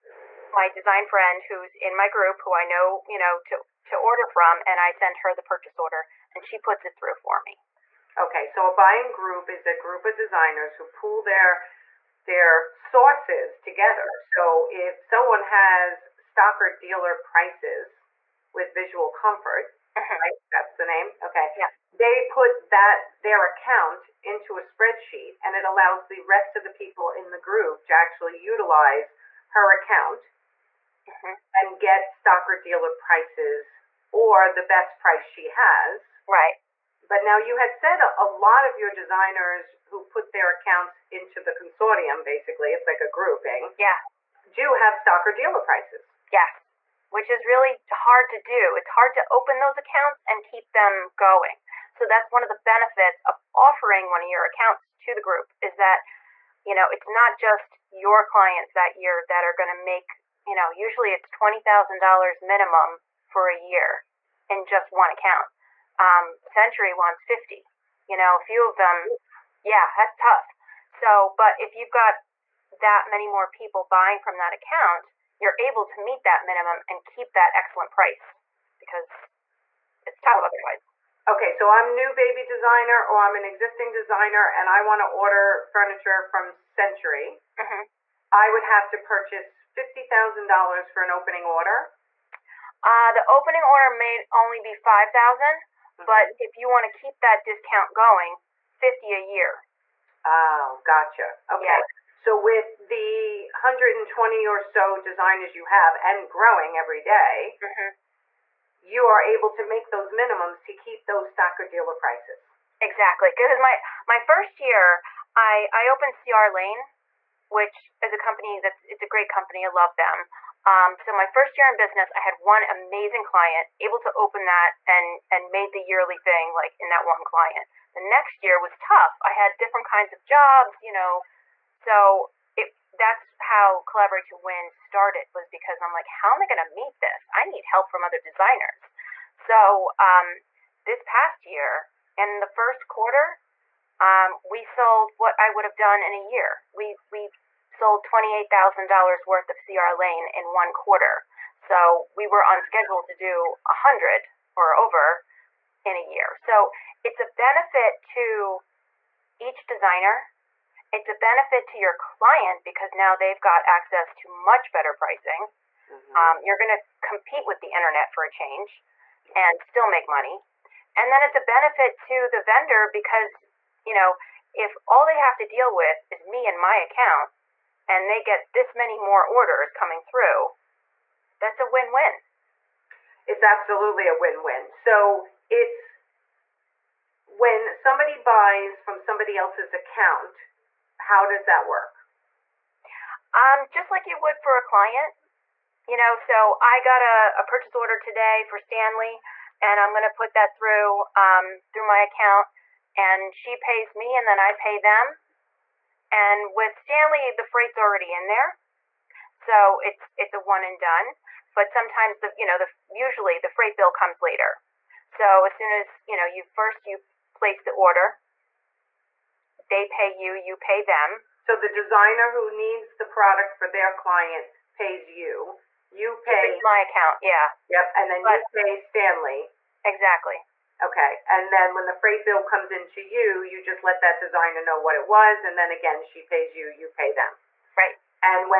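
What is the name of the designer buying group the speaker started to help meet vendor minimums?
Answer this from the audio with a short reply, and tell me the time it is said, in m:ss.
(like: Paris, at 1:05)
Collaborate to Win, at 2:13.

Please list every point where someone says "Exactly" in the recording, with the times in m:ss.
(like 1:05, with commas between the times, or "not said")
1:52, 3:49.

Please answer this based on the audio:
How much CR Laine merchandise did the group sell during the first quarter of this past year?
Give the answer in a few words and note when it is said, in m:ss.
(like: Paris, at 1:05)
$28,000, at 2:28.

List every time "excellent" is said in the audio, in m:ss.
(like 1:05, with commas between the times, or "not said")
1:17.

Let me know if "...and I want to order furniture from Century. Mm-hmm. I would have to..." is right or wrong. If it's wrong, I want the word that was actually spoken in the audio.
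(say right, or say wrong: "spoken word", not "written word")
right.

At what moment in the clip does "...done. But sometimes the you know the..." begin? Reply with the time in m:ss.
3:30.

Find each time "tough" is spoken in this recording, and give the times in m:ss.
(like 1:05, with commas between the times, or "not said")
1:10, 1:20, 2:08.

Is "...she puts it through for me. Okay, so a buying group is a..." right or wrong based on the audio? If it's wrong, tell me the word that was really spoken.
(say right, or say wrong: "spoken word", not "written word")
right.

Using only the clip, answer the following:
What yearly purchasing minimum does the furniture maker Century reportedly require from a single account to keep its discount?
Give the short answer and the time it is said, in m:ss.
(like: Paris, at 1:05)
$50,000, at 1:06.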